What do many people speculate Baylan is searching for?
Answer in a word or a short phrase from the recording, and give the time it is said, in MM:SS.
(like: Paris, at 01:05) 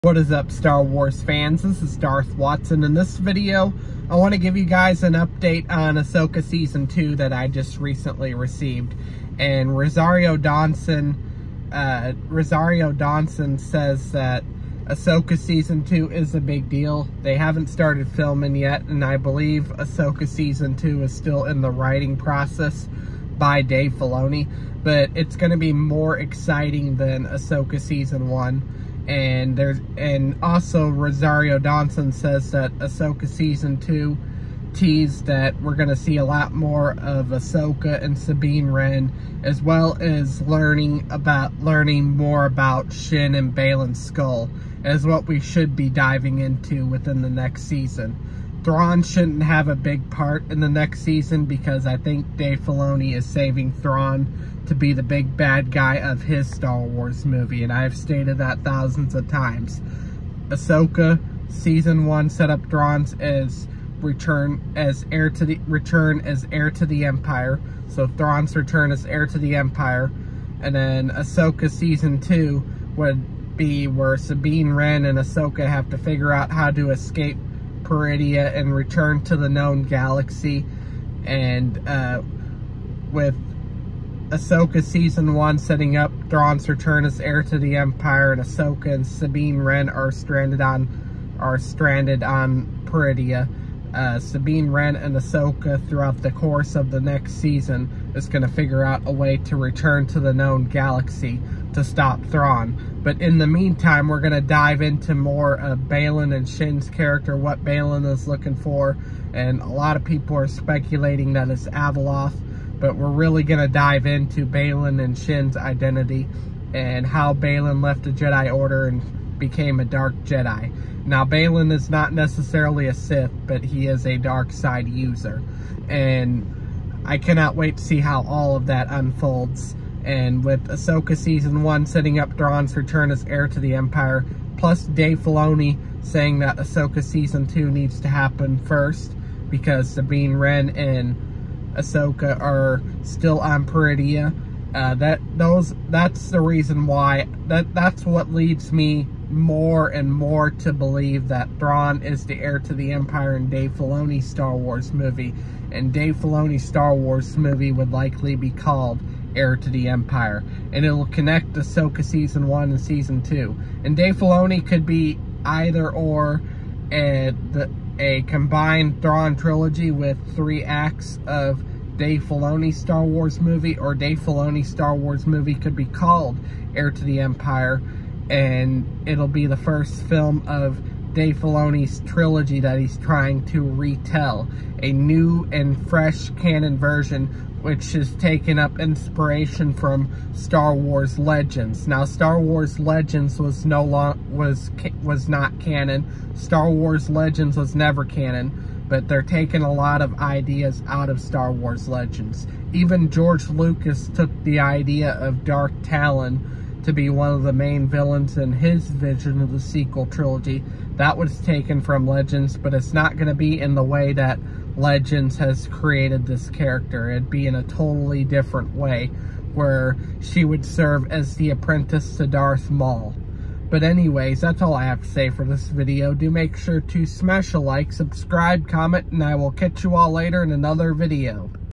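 Avaloth, at 01:51.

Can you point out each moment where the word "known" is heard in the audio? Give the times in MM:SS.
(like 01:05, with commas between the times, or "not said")
01:19, 01:40.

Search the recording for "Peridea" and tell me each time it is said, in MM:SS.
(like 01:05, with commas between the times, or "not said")
01:17, 01:32, 02:23.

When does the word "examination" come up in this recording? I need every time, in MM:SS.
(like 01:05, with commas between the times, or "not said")
not said.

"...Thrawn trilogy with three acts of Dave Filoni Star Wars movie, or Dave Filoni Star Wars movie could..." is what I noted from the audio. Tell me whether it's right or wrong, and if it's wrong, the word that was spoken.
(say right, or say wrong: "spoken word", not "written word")
right.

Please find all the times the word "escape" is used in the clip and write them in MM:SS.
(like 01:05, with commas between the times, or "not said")
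01:16.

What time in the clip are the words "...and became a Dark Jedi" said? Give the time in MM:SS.
01:58.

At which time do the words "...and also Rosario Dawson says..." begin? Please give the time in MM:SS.
00:29.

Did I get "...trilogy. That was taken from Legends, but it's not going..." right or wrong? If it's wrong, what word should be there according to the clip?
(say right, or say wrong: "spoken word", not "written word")
right.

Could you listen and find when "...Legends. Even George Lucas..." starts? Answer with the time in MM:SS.
03:21.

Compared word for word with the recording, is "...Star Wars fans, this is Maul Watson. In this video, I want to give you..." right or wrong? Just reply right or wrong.
wrong.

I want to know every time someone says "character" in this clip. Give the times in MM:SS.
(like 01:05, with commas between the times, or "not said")
01:46, 03:36.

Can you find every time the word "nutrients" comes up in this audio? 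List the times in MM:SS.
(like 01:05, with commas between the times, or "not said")
not said.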